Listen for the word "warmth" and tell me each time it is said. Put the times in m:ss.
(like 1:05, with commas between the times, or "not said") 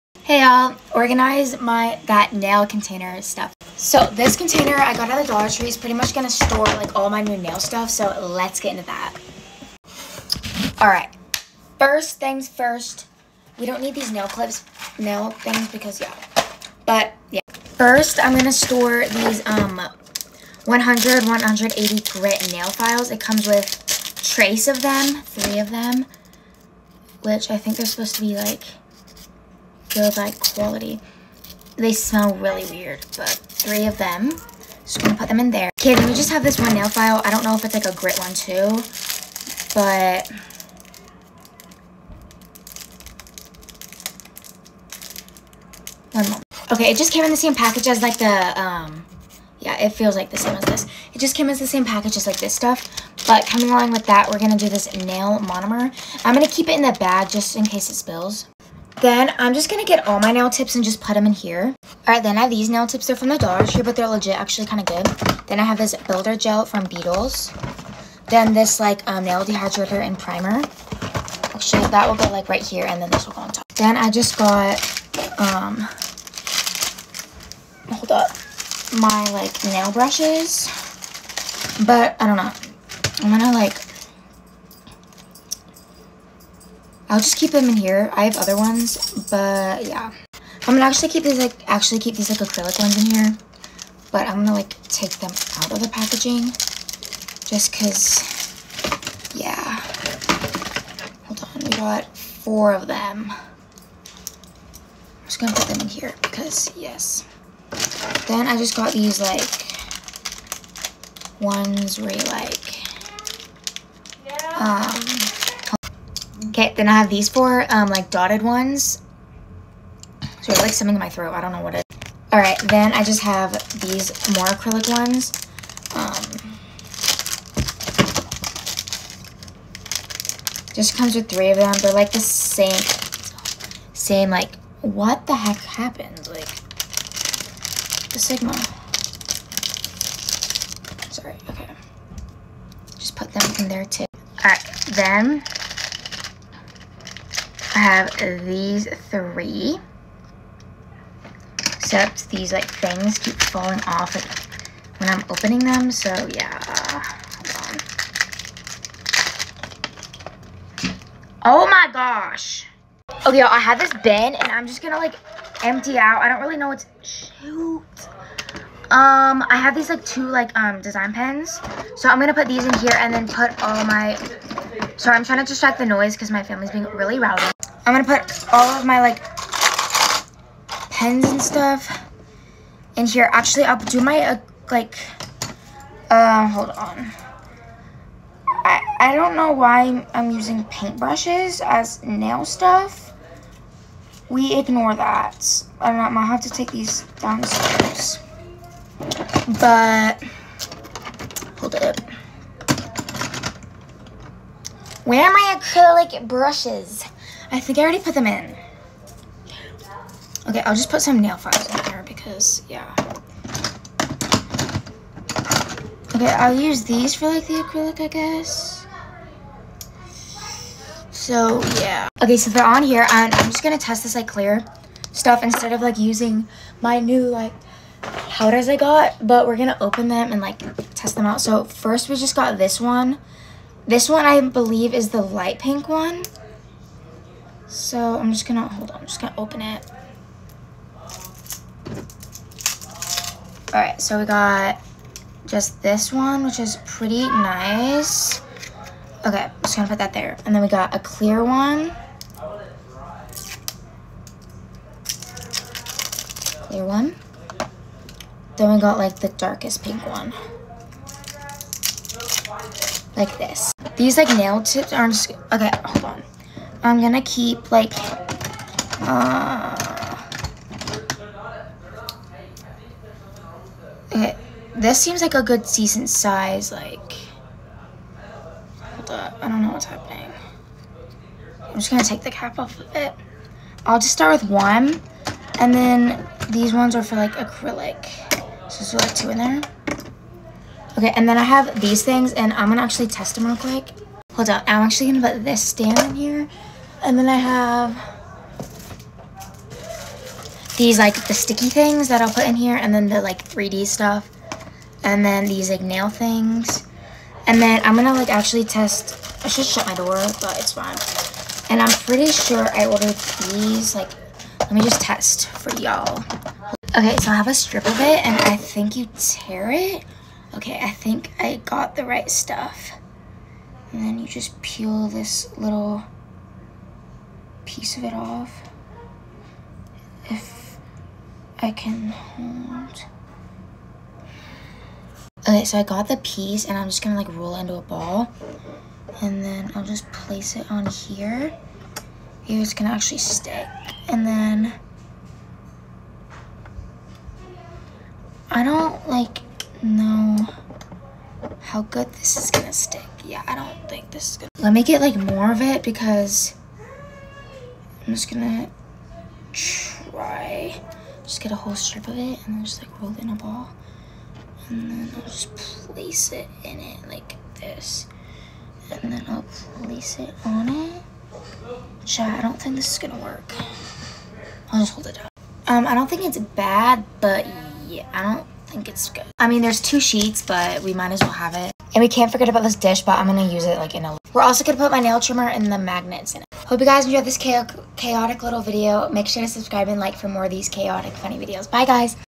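not said.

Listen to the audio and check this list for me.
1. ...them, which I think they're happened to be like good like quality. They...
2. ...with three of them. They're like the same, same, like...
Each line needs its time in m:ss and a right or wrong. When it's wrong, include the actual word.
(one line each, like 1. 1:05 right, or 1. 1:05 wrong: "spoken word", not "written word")
1. 0:25 wrong: "supposed", not "happened"
2. 2:11 right.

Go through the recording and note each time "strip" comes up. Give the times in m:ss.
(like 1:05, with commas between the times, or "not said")
5:17, 6:01.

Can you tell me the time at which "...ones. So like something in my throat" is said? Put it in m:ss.
1:58.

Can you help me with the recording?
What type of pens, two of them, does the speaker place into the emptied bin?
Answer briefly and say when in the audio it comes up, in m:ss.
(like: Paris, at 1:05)
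design pens, at 2:50.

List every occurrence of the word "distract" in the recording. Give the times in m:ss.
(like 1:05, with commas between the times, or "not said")
2:55.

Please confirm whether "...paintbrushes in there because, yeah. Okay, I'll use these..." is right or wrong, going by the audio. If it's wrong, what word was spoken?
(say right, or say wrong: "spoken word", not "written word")
wrong: "files", not "paintbrushes".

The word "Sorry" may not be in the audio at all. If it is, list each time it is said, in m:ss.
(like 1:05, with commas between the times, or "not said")
2:21, 2:55.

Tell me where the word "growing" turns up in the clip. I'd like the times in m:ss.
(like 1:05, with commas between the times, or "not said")
not said.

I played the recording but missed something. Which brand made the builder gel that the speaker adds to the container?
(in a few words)
Beetles.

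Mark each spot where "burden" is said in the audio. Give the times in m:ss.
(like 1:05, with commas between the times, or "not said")
not said.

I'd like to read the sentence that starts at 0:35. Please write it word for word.
Okay, then we just have this one nail file.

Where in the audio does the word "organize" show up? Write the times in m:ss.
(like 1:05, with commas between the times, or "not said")
0:00.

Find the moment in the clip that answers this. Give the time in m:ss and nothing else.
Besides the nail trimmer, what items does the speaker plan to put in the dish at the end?
6:25.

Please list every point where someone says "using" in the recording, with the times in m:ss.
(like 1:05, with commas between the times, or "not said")
3:10, 3:45.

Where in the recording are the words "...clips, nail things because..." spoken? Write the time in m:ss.
0:14.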